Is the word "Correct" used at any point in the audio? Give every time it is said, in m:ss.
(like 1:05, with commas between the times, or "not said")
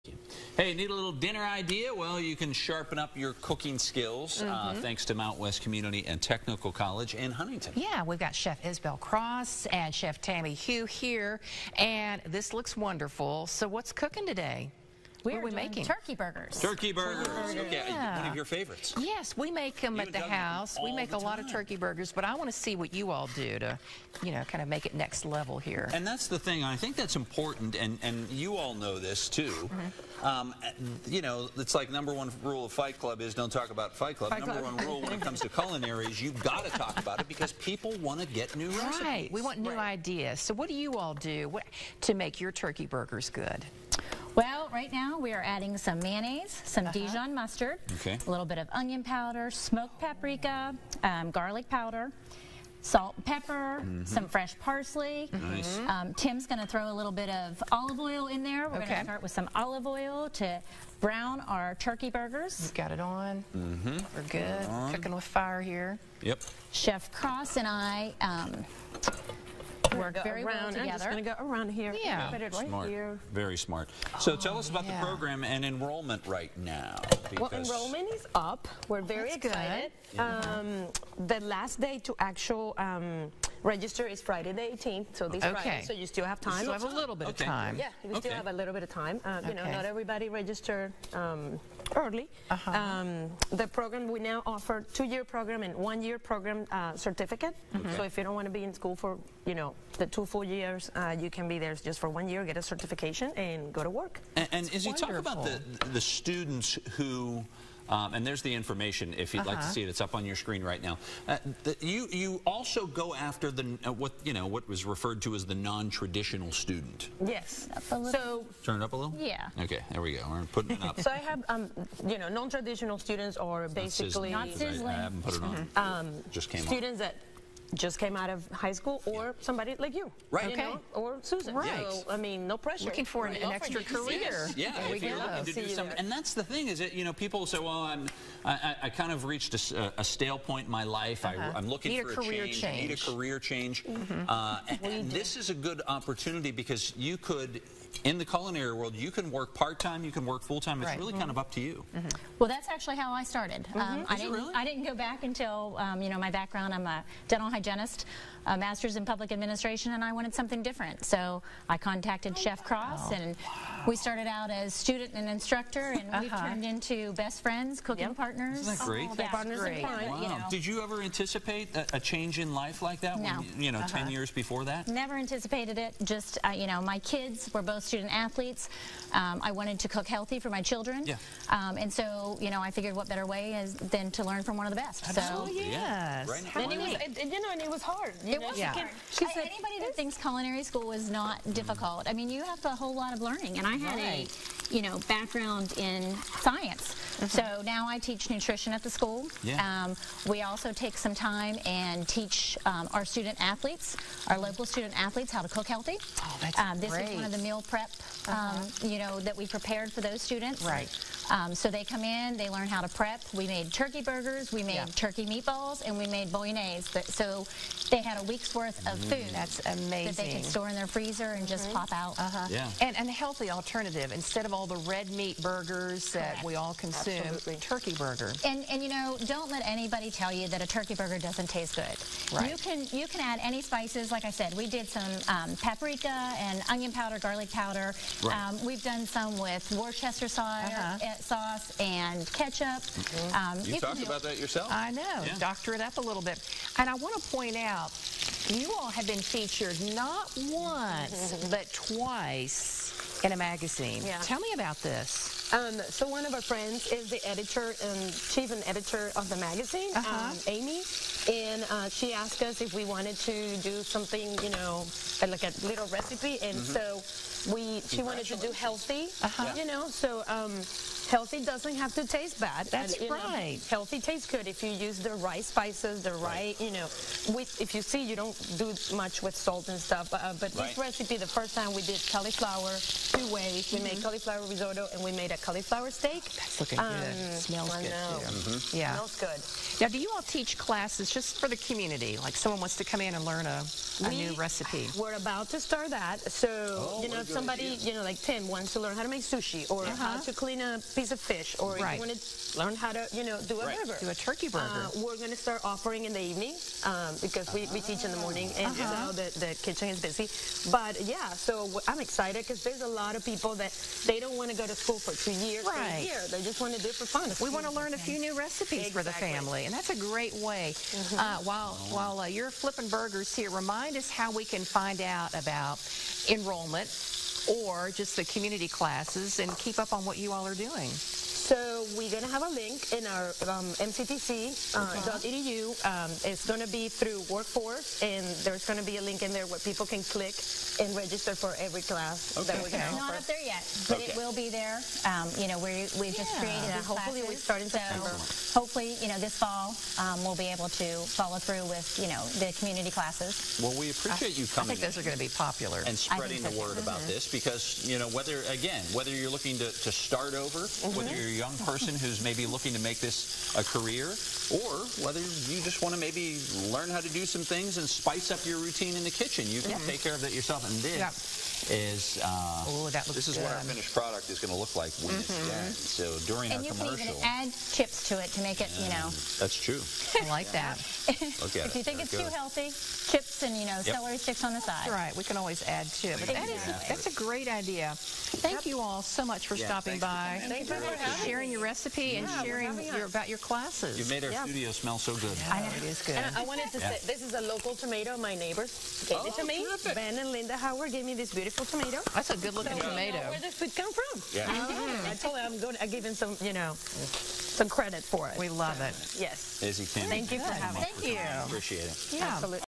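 3:46.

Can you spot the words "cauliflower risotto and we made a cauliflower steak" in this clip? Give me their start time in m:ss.
4:44.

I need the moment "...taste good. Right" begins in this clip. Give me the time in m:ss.
3:51.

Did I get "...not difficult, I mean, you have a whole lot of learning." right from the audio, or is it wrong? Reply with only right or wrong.
right.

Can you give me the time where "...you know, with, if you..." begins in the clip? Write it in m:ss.
4:36.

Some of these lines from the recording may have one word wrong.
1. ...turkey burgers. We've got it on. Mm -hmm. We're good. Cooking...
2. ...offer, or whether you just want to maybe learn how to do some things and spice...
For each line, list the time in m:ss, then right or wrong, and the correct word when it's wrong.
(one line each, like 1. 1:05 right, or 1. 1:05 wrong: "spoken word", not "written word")
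1. 1:01 right
2. 6:03 wrong: "career", not "offer".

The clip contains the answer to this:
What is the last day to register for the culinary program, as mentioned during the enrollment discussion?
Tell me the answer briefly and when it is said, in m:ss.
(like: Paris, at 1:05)
Friday the 18th, at 1:24.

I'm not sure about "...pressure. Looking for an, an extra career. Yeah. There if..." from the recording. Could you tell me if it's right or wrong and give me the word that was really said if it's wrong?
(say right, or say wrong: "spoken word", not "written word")
right.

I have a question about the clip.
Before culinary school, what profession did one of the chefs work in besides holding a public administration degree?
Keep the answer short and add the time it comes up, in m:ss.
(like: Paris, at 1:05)
Dental hygienist, at 2:37.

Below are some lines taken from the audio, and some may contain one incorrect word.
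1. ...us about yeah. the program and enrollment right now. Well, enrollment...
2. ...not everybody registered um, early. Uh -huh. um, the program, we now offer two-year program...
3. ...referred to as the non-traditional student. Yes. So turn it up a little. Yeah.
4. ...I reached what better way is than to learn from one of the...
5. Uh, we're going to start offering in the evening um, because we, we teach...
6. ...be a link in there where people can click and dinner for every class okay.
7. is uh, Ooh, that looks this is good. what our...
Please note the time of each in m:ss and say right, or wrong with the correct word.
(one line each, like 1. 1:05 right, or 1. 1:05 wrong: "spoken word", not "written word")
1. 1:14 right
2. 1:29 right
3. 1:54 right
4. 3:02 wrong: "figured", not "reached"
5. 5:04 right
6. 5:38 wrong: "register", not "dinner"
7. 6:11 right.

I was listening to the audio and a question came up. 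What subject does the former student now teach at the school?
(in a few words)
Nutrition.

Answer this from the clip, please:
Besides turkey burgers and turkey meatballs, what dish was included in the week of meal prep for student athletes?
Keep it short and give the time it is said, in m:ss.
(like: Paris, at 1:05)
Bolognese, at 3:36.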